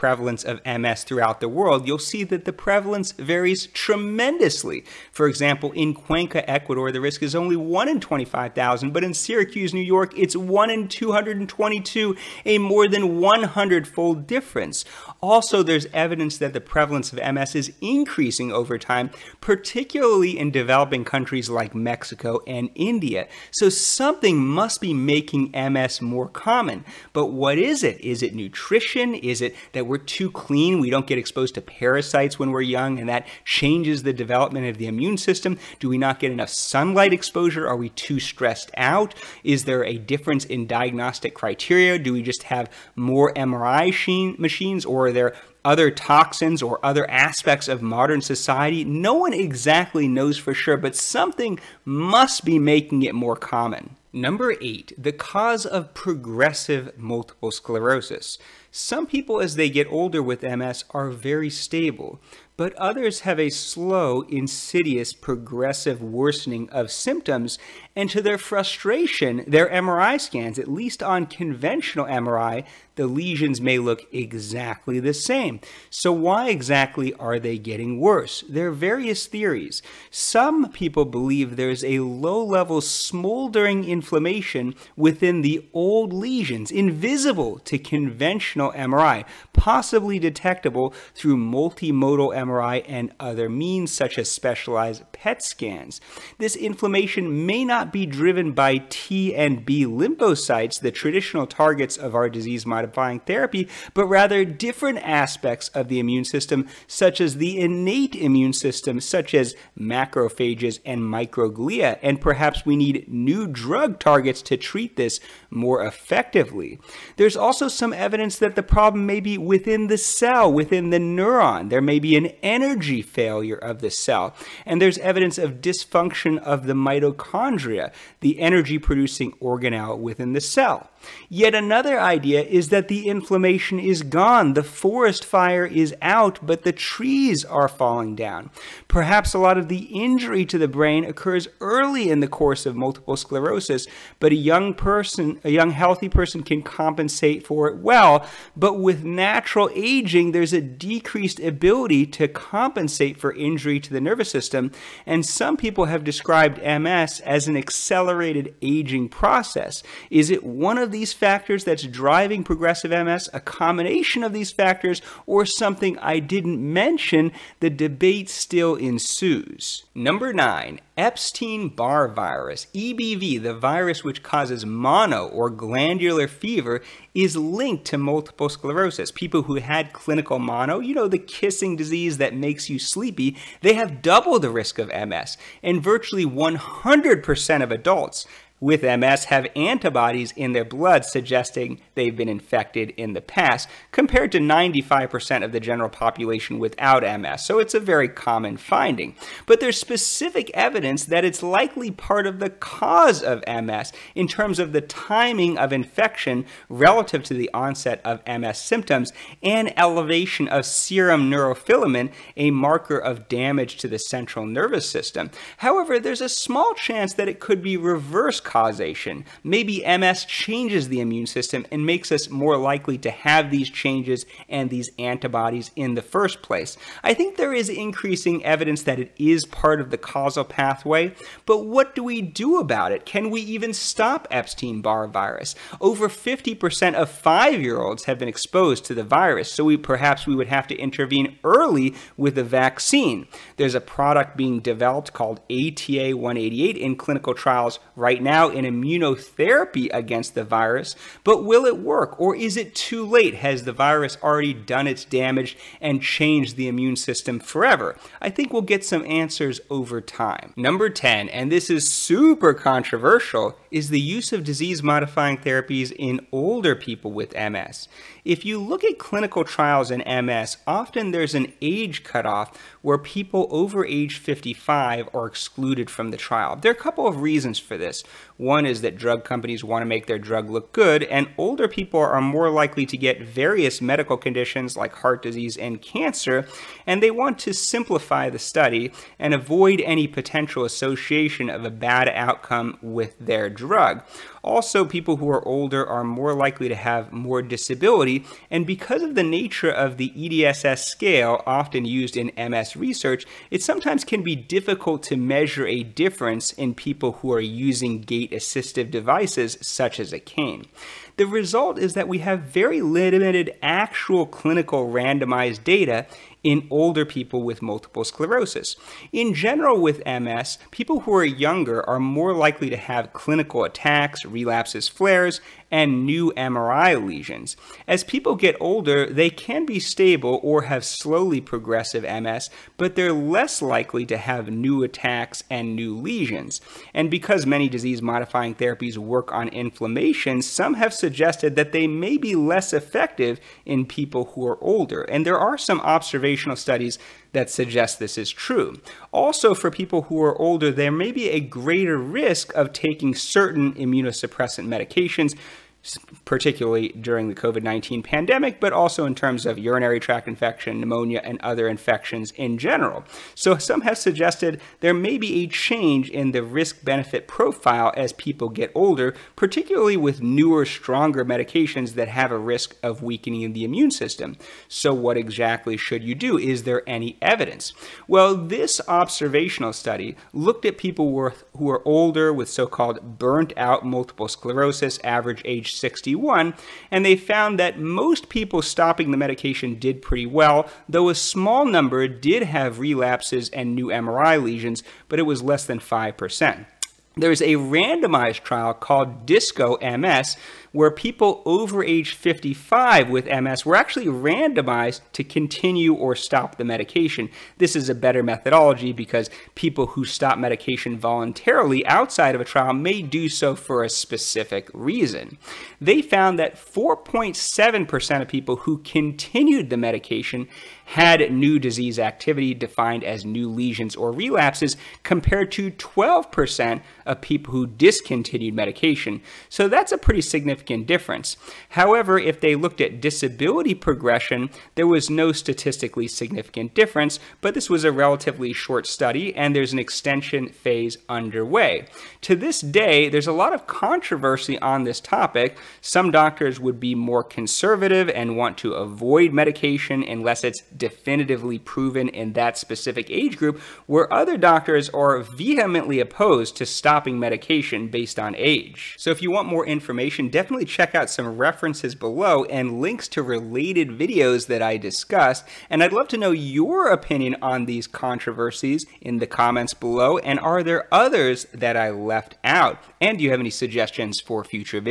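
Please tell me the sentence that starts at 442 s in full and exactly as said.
To this day, there's a lot of controversy on this topic.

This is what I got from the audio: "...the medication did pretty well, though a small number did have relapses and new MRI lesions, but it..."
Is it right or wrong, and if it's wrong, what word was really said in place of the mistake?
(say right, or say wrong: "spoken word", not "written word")
right.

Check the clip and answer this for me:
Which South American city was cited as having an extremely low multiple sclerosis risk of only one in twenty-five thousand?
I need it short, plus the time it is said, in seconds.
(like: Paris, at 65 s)
Cuenca, Ecuador, at 5 s.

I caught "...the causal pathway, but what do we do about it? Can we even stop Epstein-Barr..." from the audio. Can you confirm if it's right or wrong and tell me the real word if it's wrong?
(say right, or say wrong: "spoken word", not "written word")
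right.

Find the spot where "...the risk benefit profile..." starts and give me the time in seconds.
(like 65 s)
366 s.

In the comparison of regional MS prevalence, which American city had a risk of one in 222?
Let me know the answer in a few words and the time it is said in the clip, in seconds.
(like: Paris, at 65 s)
Syracuse, New York, at 9 s.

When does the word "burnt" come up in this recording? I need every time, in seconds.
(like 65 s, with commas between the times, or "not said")
383 s.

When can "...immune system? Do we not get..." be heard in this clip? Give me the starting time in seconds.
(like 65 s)
34 s.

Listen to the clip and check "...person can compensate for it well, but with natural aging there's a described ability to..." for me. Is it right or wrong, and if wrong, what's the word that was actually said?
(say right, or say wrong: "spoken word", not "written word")
wrong: "decreased", not "described".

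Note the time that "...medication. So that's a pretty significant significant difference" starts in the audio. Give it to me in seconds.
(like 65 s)
428 s.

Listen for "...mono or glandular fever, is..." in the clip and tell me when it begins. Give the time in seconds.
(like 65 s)
174 s.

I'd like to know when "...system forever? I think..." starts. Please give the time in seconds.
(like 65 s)
256 s.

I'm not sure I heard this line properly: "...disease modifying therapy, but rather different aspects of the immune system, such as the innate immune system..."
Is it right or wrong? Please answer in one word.
right.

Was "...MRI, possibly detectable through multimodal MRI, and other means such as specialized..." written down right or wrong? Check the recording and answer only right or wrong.
right.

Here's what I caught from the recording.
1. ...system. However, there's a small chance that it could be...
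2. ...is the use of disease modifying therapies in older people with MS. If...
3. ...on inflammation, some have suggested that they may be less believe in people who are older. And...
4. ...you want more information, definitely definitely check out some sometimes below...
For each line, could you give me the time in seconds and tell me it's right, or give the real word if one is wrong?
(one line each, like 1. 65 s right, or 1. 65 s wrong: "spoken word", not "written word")
1. 214 s right
2. 263 s right
3. 339 s wrong: "effective", not "believe"
4. 459 s wrong: "references", not "sometimes".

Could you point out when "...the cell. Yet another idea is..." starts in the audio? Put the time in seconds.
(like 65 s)
130 s.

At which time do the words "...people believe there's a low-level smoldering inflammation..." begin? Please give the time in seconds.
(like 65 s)
80 s.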